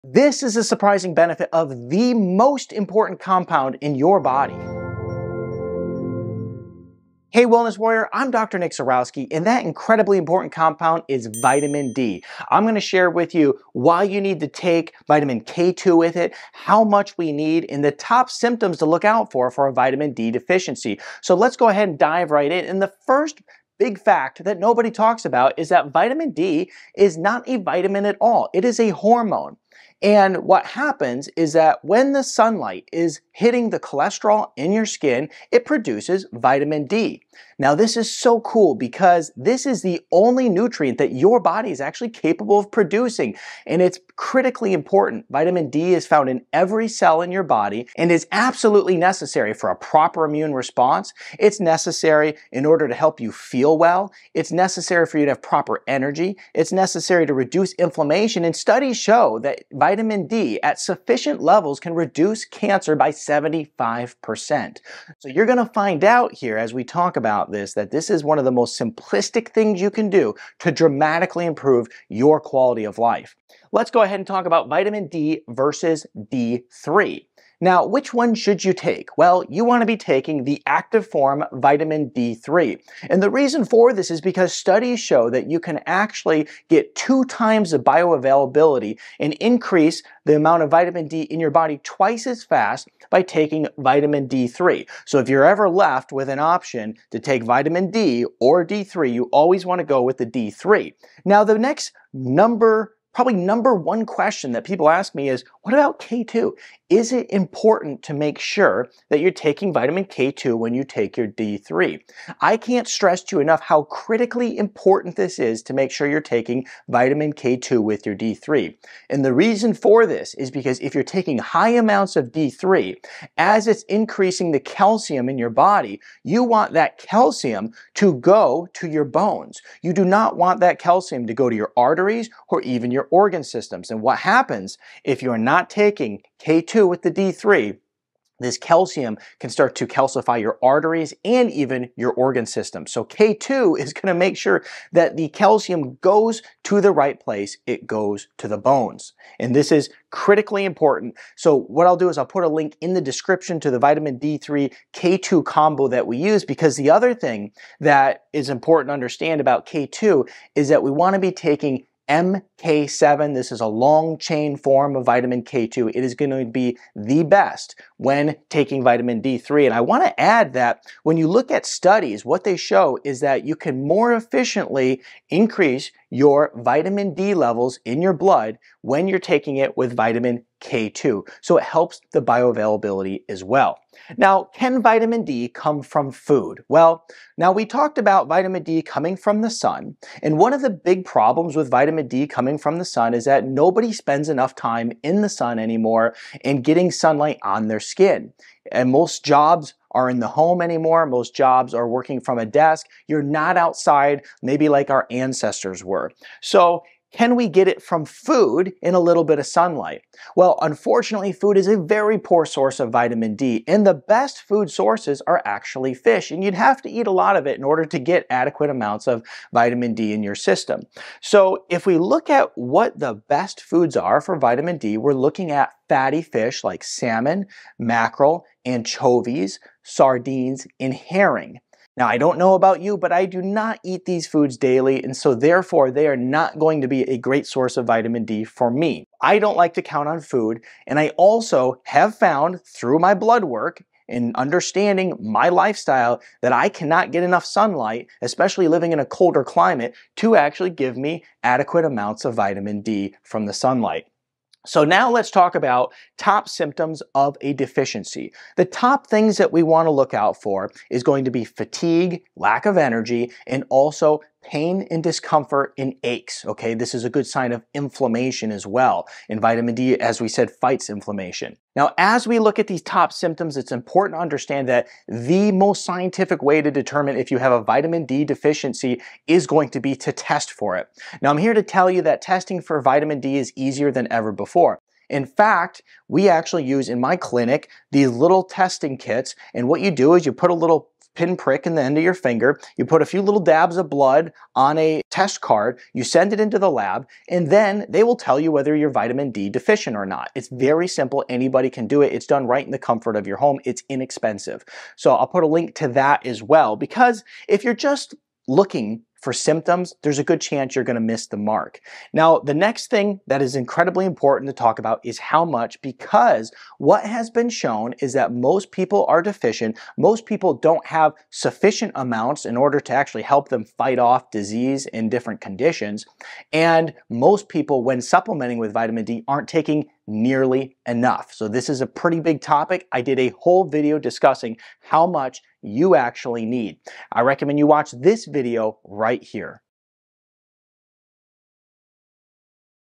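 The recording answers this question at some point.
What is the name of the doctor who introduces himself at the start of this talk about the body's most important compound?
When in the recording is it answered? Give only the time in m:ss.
0:08.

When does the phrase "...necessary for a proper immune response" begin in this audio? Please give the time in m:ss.
0:48.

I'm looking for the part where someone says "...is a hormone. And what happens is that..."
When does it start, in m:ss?
0:28.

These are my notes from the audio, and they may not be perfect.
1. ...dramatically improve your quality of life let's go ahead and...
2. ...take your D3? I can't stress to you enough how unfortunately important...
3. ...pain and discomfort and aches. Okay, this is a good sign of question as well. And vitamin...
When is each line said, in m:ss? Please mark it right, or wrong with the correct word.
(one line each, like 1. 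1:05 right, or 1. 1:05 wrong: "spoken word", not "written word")
1. 1:10 right
2. 1:50 wrong: "critically", not "unfortunately"
3. 4:24 wrong: "inflammation", not "question".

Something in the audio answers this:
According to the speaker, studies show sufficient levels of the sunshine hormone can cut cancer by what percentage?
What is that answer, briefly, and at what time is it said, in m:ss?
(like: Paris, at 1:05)
75%, at 1:03.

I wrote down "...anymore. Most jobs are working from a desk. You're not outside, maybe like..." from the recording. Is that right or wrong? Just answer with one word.
right.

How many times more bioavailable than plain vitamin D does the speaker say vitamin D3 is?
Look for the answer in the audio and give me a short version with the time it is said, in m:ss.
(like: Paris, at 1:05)
2 times, at 1:26.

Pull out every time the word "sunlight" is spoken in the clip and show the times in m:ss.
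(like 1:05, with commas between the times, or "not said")
0:32, 3:16, 3:29, 4:07, 4:13.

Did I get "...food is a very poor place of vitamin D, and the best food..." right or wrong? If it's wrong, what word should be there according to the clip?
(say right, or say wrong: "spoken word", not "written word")
wrong: "source", not "place".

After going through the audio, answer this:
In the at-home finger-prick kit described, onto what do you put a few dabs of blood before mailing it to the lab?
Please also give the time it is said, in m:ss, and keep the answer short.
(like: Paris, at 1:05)
test card, at 4:55.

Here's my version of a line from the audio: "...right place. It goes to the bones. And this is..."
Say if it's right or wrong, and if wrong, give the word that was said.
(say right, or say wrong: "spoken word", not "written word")
right.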